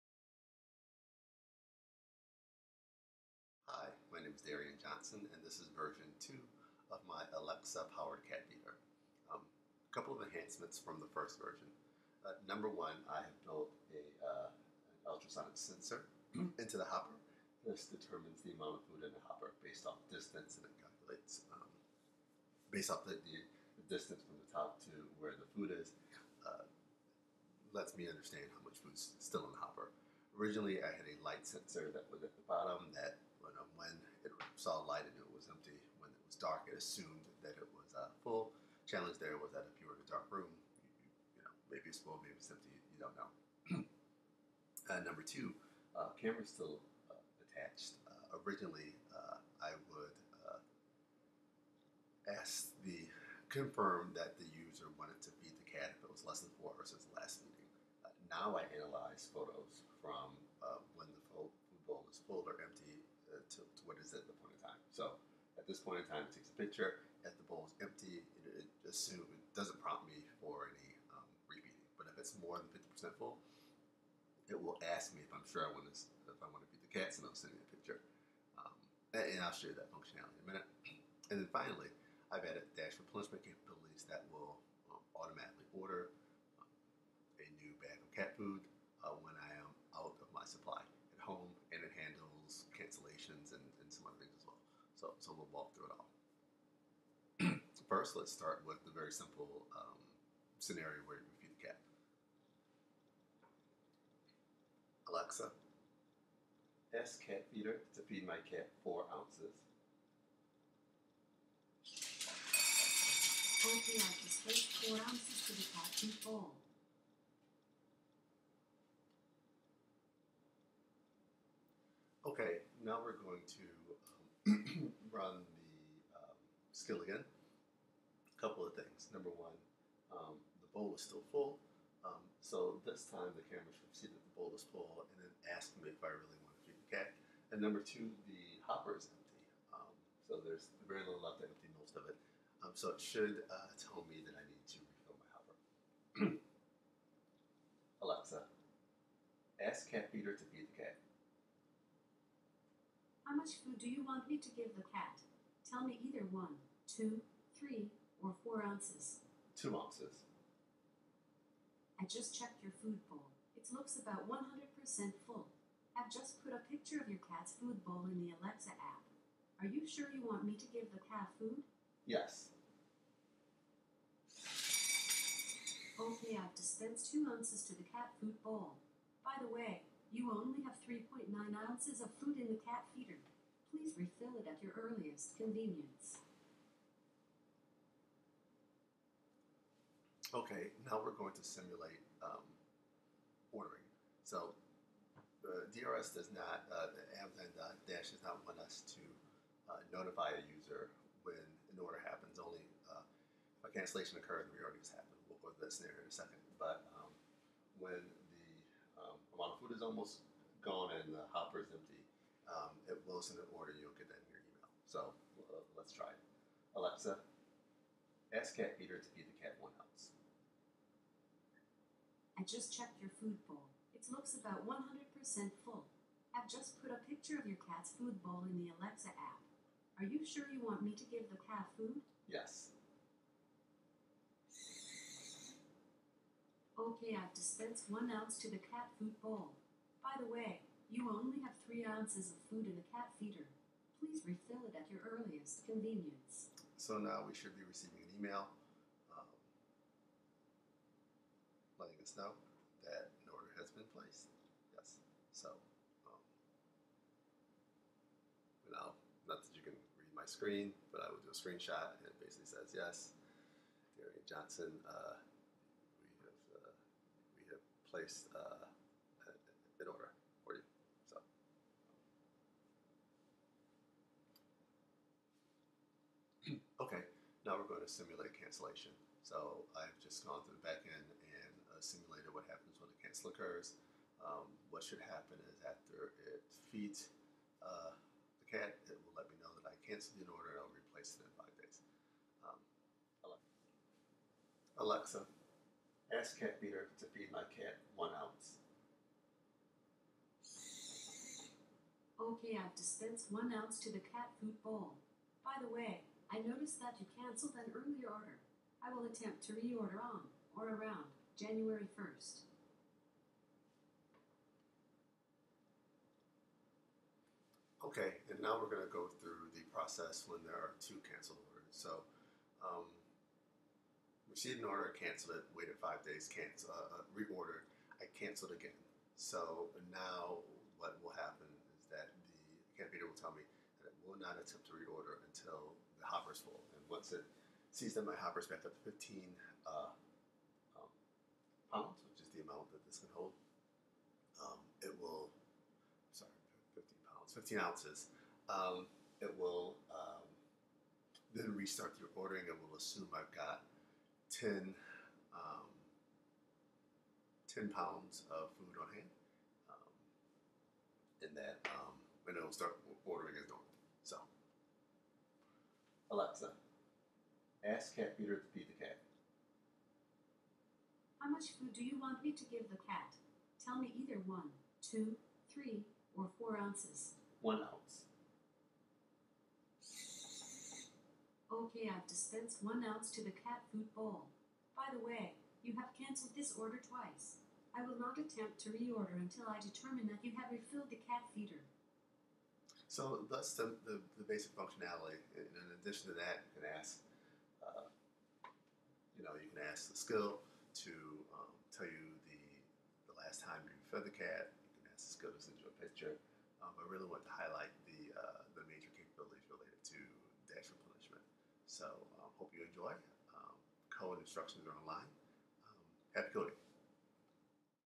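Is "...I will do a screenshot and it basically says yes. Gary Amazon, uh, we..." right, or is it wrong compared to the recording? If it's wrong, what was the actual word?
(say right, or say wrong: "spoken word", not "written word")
wrong: "Johnson", not "Amazon".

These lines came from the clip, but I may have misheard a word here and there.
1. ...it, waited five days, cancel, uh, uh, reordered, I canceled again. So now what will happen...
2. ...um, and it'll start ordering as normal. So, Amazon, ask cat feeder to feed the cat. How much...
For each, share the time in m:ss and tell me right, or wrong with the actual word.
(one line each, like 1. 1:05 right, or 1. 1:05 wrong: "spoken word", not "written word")
1. 5:25 right
2. 6:01 wrong: "Alexa", not "Amazon".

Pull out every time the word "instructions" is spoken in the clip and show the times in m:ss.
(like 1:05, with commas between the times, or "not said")
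6:54.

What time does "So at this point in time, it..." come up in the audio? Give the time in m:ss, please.
1:04.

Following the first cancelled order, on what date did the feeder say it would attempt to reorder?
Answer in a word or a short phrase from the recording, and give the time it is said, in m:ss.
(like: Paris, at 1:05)
January 1st, at 5:11.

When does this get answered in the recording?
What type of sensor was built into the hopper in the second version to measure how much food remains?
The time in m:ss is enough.
0:15.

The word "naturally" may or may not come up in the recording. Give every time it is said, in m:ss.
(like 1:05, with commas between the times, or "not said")
not said.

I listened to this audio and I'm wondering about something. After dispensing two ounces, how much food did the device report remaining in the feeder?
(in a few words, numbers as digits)
3.9 ounces.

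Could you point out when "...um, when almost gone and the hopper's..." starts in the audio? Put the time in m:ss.
3:26.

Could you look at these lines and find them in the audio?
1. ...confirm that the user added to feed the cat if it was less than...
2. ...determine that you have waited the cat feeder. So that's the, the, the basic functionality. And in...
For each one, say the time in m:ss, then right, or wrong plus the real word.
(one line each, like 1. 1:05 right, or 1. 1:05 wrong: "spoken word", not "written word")
1. 0:53 wrong: "wanted", not "added"
2. 6:29 wrong: "refilled", not "waited".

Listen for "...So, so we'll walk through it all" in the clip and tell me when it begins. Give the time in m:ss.
1:35.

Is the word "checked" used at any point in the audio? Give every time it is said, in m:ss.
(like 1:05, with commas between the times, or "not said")
2:42, 3:42.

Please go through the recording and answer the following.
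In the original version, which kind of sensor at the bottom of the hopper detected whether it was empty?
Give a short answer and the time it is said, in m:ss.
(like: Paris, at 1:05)
light sensor, at 0:31.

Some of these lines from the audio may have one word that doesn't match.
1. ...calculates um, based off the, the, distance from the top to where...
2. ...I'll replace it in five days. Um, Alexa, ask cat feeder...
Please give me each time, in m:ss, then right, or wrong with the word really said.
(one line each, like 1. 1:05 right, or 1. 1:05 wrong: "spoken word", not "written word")
1. 0:20 right
2. 4:50 right.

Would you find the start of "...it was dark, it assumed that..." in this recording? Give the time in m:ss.
0:36.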